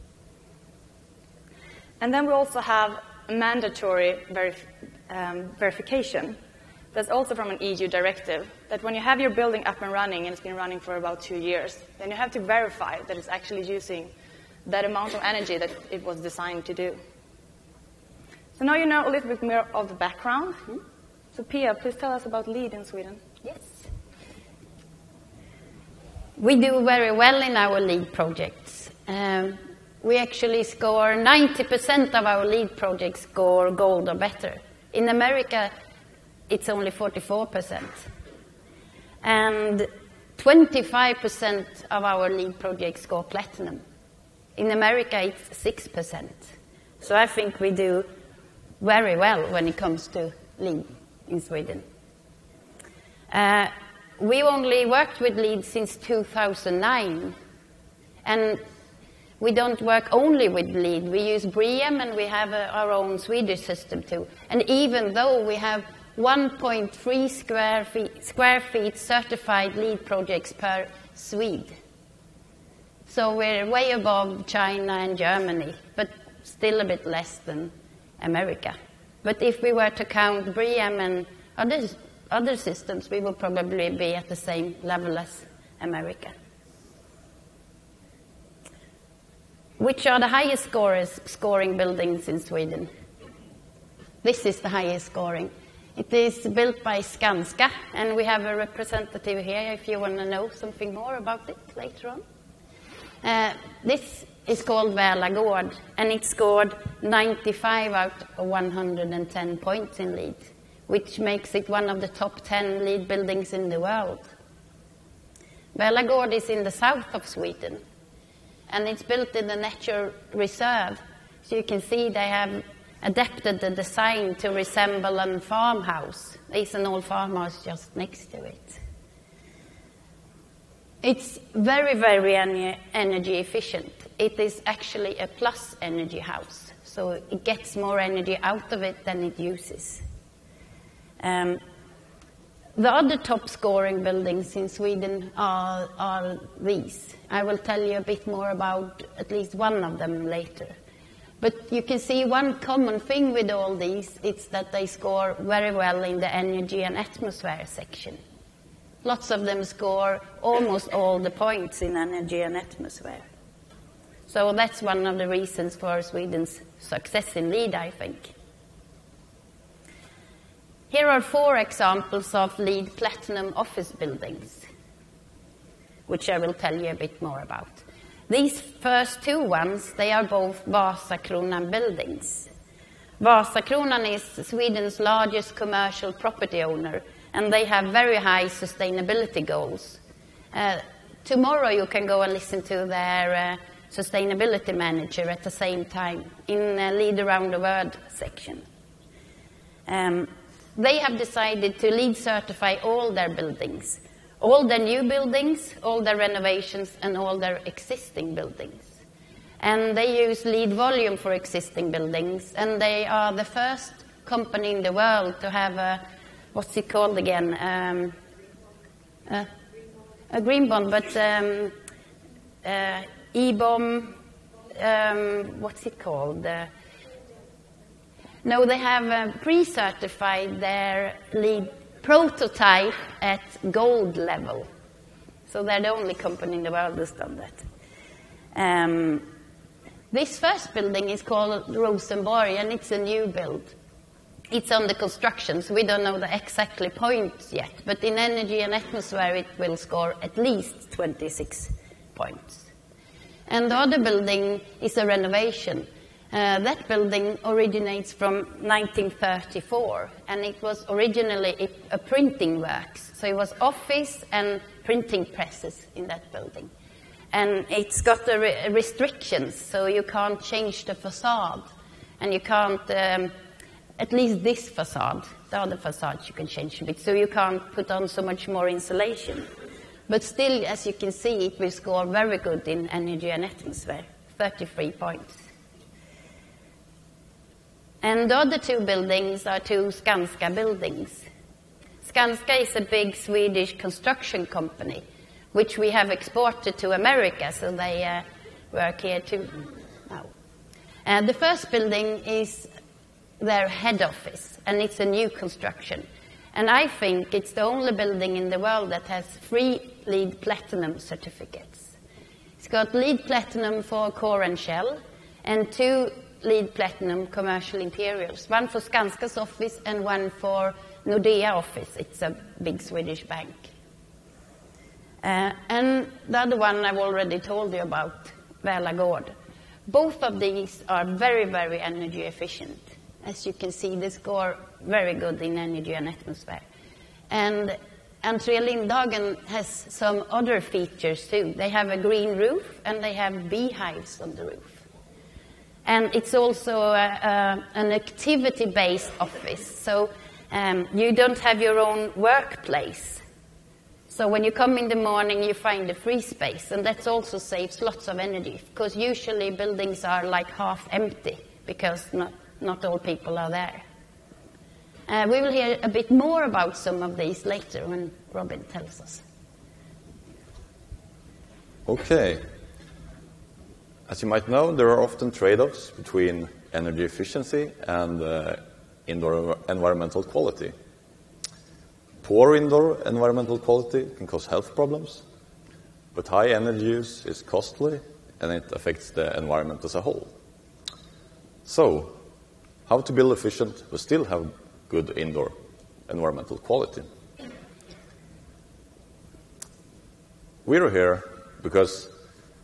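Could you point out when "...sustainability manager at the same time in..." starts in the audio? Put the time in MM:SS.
03:13.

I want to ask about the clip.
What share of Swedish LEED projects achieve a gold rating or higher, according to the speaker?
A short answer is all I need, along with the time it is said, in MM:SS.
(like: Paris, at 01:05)
90%, at 00:31.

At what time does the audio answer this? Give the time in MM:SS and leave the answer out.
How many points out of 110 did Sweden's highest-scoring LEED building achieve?
01:47.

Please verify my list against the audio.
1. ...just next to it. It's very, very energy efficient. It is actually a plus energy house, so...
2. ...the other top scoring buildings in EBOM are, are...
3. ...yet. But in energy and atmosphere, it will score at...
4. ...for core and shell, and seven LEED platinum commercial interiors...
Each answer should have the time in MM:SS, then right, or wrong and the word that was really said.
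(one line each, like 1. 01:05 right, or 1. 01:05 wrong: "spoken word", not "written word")
1. 02:07 right
2. 02:22 wrong: "Sweden", not "EBOM"
3. 04:07 right
4. 05:13 wrong: "two", not "seven".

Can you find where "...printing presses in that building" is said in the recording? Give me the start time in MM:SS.
04:24.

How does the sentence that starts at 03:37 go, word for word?
Um, a, a green bond, but um, uh, EBOM, um, what's it called?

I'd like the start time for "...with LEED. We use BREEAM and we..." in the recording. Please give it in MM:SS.
01:00.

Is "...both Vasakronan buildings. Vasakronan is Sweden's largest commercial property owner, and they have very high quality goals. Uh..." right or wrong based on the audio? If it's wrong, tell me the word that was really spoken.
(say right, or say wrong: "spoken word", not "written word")
wrong: "sustainability", not "quality".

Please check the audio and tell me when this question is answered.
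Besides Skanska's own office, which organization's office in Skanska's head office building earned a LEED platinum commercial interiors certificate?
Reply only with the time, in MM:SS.
05:21.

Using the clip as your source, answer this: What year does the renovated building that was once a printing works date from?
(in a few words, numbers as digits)
1934.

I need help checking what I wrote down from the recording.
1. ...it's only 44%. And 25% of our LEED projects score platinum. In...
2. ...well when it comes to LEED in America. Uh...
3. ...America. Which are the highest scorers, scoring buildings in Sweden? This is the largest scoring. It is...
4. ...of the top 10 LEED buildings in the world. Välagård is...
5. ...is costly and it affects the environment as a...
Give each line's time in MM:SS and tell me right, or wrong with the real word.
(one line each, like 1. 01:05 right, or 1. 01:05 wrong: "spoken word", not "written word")
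1. 00:36 right
2. 00:49 wrong: "Sweden", not "America"
3. 01:25 wrong: "highest", not "largest"
4. 01:51 right
5. 06:27 right.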